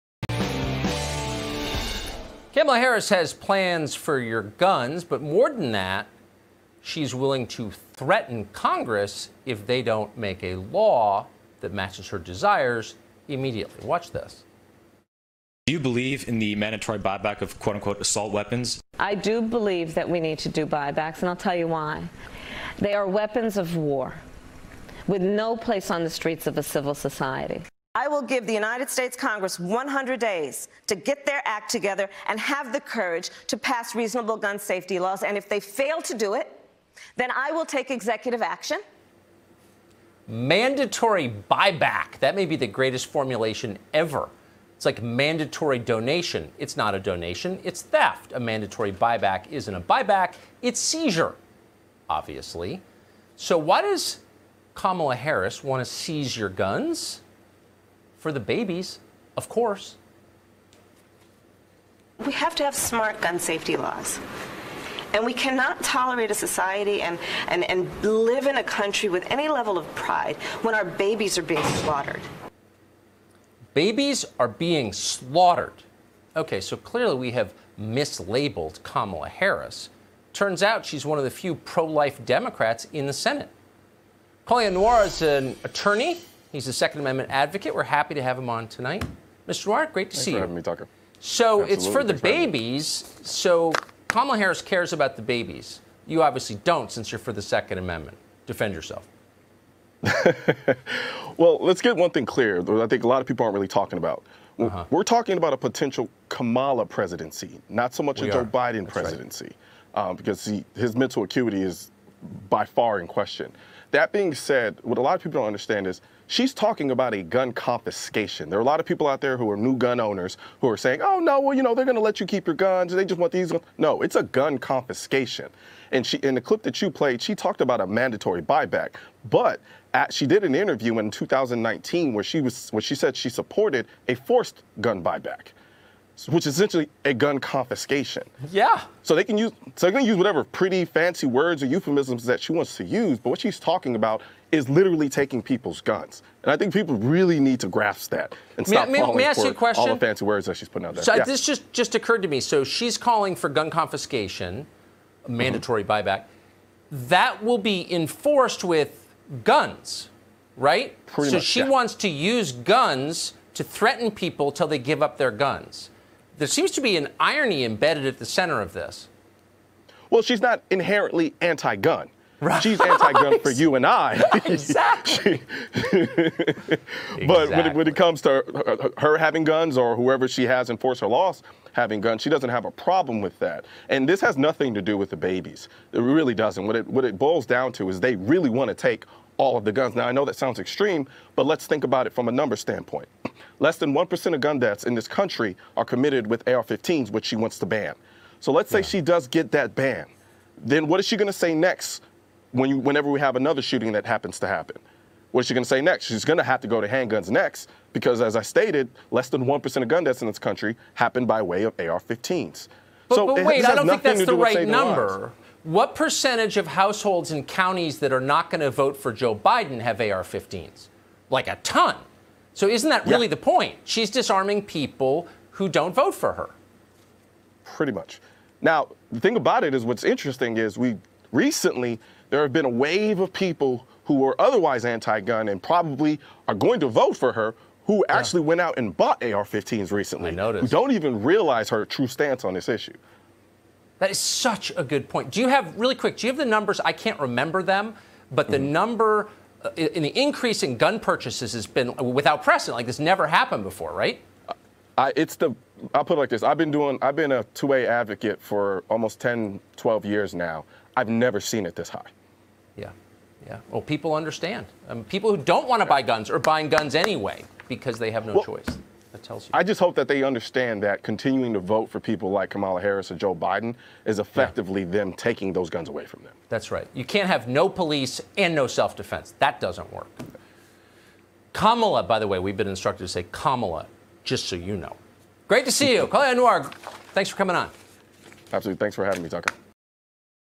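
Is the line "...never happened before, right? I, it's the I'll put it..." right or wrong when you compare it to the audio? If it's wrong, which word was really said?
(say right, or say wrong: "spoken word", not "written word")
right.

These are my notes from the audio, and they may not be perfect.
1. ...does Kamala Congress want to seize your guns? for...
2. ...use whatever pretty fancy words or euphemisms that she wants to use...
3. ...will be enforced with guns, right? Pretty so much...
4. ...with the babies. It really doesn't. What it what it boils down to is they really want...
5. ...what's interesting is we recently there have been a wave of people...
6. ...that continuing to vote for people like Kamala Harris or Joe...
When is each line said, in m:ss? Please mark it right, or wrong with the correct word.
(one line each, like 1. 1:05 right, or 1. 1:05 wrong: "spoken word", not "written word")
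1. 0:53 wrong: "Harris", not "Congress"
2. 2:20 right
3. 2:37 right
4. 3:04 right
5. 3:49 right
6. 4:30 right.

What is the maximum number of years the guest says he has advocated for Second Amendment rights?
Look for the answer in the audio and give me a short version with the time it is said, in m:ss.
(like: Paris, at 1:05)
12, at 4:19.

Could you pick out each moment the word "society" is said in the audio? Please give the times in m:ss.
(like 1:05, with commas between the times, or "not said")
0:26, 1:06.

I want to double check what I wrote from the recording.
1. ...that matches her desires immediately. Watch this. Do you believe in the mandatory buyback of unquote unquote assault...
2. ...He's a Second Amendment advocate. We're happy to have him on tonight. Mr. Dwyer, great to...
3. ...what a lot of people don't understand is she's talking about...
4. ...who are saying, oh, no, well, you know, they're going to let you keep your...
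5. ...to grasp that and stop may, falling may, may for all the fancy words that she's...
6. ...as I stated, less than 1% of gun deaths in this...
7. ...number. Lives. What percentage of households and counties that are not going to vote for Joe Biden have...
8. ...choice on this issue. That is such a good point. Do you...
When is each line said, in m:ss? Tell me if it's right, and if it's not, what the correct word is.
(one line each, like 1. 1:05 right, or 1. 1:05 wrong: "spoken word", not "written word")
1. 0:11 wrong: "quote", not "unquote"
2. 1:26 right
3. 1:54 right
4. 2:00 right
5. 2:27 right
6. 3:28 right
7. 3:34 right
8. 4:02 wrong: "stance", not "choice".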